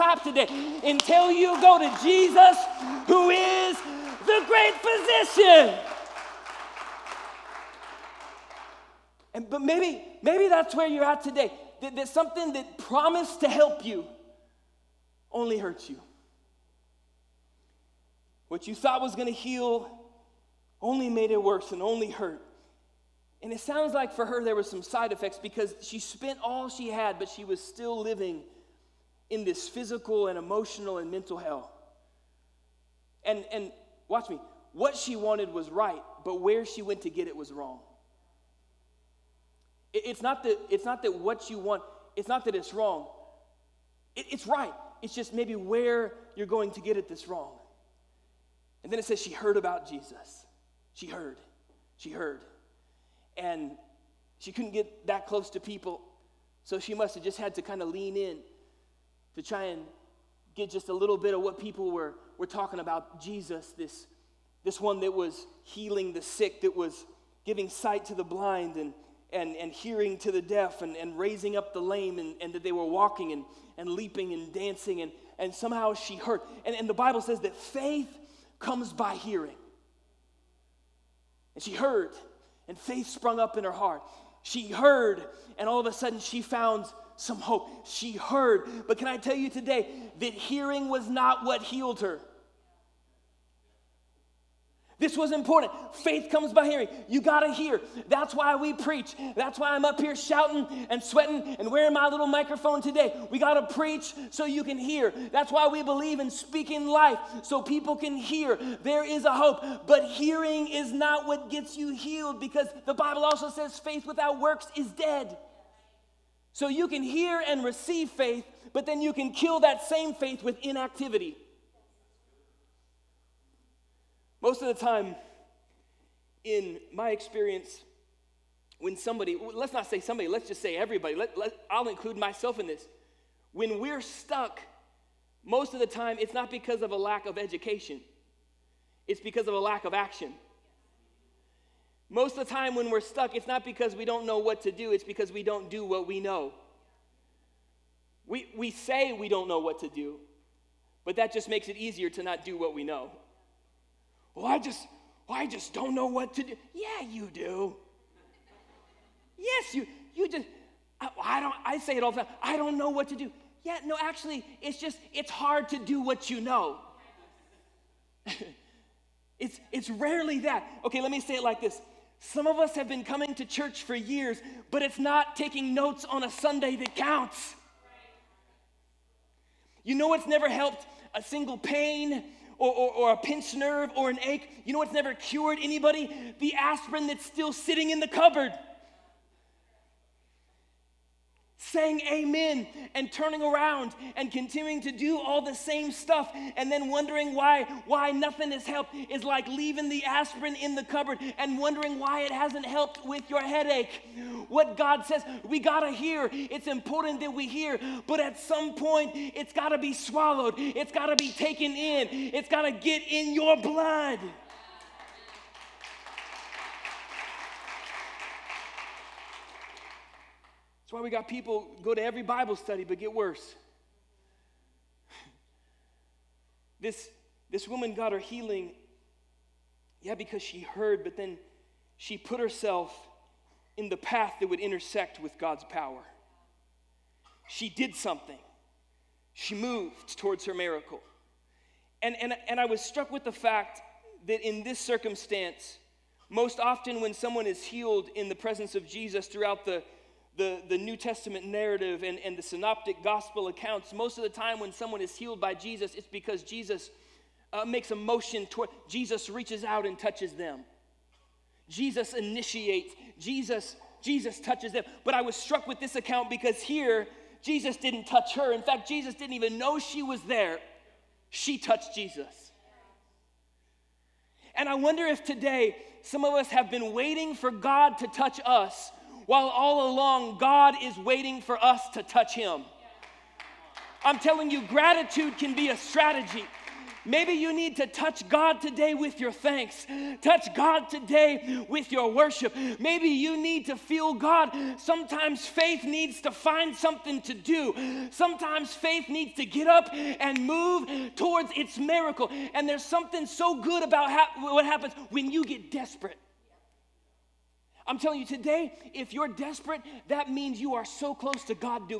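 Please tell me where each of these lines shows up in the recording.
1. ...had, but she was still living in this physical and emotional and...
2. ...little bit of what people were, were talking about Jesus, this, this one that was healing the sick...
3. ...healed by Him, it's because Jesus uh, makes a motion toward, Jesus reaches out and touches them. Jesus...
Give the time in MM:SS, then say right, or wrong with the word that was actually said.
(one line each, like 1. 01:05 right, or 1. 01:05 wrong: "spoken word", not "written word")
1. 00:26 right
2. 01:00 right
3. 04:15 wrong: "Jesus", not "Him".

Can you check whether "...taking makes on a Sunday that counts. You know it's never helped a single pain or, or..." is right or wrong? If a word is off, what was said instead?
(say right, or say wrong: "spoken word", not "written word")
wrong: "notes", not "makes".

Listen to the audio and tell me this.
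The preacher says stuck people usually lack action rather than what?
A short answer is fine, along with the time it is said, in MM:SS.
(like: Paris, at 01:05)
education, at 02:17.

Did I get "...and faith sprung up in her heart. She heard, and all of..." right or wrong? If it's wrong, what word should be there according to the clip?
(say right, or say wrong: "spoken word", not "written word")
right.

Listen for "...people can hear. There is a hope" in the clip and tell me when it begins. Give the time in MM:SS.
01:47.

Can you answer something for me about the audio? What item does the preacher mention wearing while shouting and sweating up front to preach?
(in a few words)
little microphone.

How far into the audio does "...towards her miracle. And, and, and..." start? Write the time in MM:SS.
04:00.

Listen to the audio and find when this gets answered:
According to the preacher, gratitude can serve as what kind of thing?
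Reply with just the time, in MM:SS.
04:45.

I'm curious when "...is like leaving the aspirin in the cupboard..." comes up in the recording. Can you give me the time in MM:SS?
03:19.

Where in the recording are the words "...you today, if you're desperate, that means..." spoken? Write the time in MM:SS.
05:08.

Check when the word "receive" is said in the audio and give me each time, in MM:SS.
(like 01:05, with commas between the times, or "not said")
01:57.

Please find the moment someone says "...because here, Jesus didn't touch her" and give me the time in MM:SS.
04:26.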